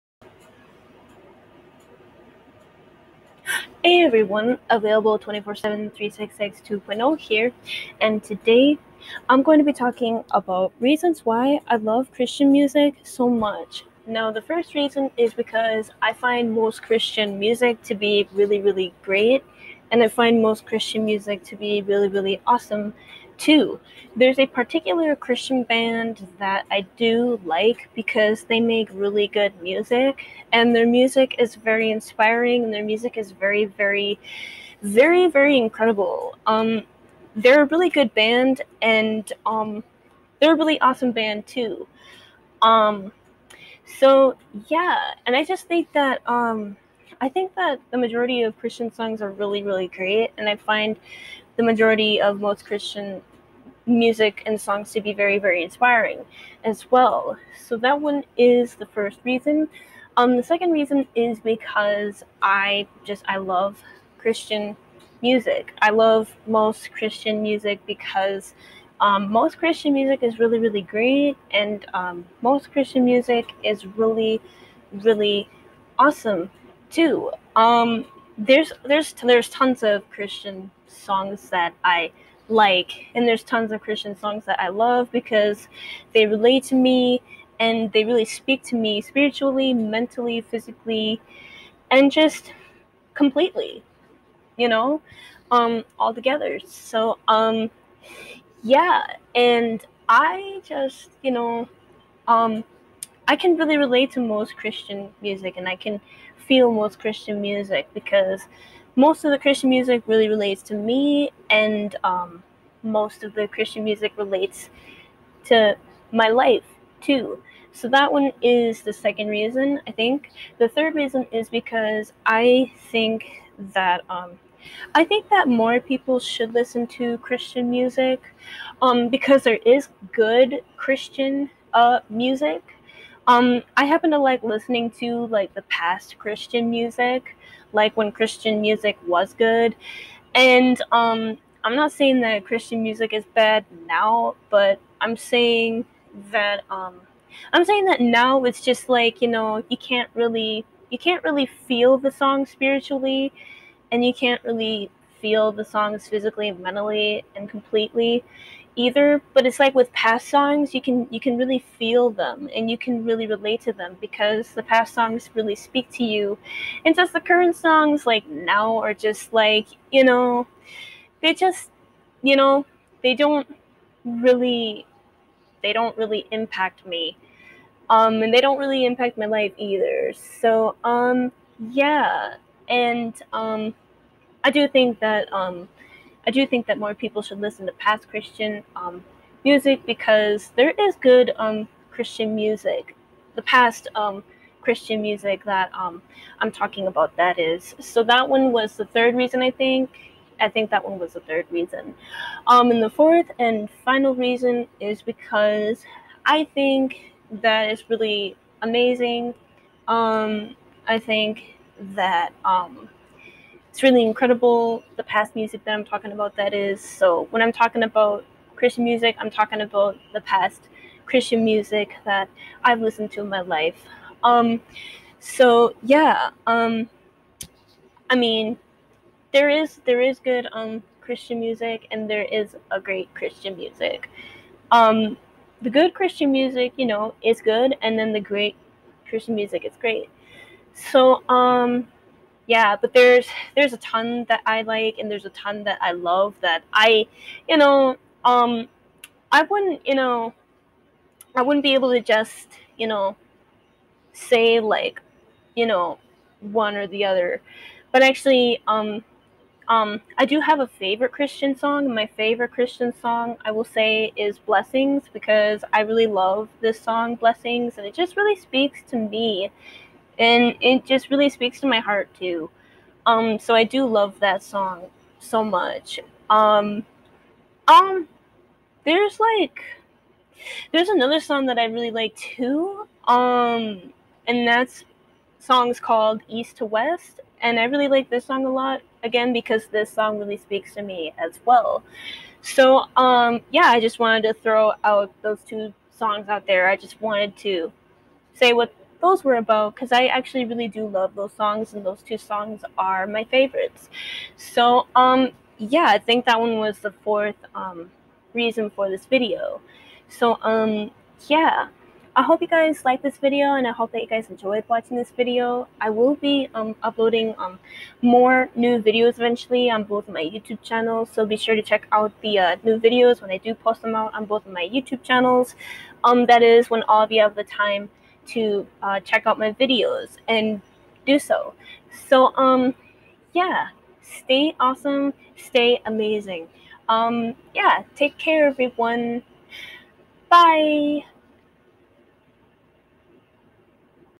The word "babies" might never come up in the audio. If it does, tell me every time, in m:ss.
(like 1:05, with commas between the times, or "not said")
not said.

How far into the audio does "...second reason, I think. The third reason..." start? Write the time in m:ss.
1:58.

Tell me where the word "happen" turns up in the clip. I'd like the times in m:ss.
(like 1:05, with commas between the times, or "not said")
2:13.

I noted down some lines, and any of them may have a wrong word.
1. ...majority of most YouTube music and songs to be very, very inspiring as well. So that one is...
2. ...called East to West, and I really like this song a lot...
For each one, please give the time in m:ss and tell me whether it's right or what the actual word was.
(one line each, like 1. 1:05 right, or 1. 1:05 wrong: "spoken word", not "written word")
1. 0:51 wrong: "Christian", not "YouTube"
2. 4:45 right.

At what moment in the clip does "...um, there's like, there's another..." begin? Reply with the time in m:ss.
4:37.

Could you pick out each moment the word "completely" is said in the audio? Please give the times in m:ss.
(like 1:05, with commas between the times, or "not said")
1:33, 2:37.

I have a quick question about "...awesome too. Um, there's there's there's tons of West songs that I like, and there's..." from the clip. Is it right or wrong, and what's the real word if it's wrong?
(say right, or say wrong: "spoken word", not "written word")
wrong: "Christian", not "West".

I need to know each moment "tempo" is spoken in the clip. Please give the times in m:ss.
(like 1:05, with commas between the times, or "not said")
not said.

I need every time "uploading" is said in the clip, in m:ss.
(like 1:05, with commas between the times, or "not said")
5:16.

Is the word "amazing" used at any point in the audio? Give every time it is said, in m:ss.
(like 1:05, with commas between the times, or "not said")
3:28, 5:35.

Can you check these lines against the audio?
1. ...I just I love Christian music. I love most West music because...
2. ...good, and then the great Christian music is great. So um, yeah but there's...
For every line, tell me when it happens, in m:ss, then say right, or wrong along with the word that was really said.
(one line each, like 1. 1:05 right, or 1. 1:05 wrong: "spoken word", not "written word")
1. 1:02 wrong: "Christian", not "West"
2. 3:57 right.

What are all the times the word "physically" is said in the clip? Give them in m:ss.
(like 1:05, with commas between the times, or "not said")
1:30, 2:36.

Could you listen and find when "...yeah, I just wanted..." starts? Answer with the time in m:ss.
4:53.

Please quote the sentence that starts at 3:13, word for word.
The past um, Christian music that um, I'm talking about that is.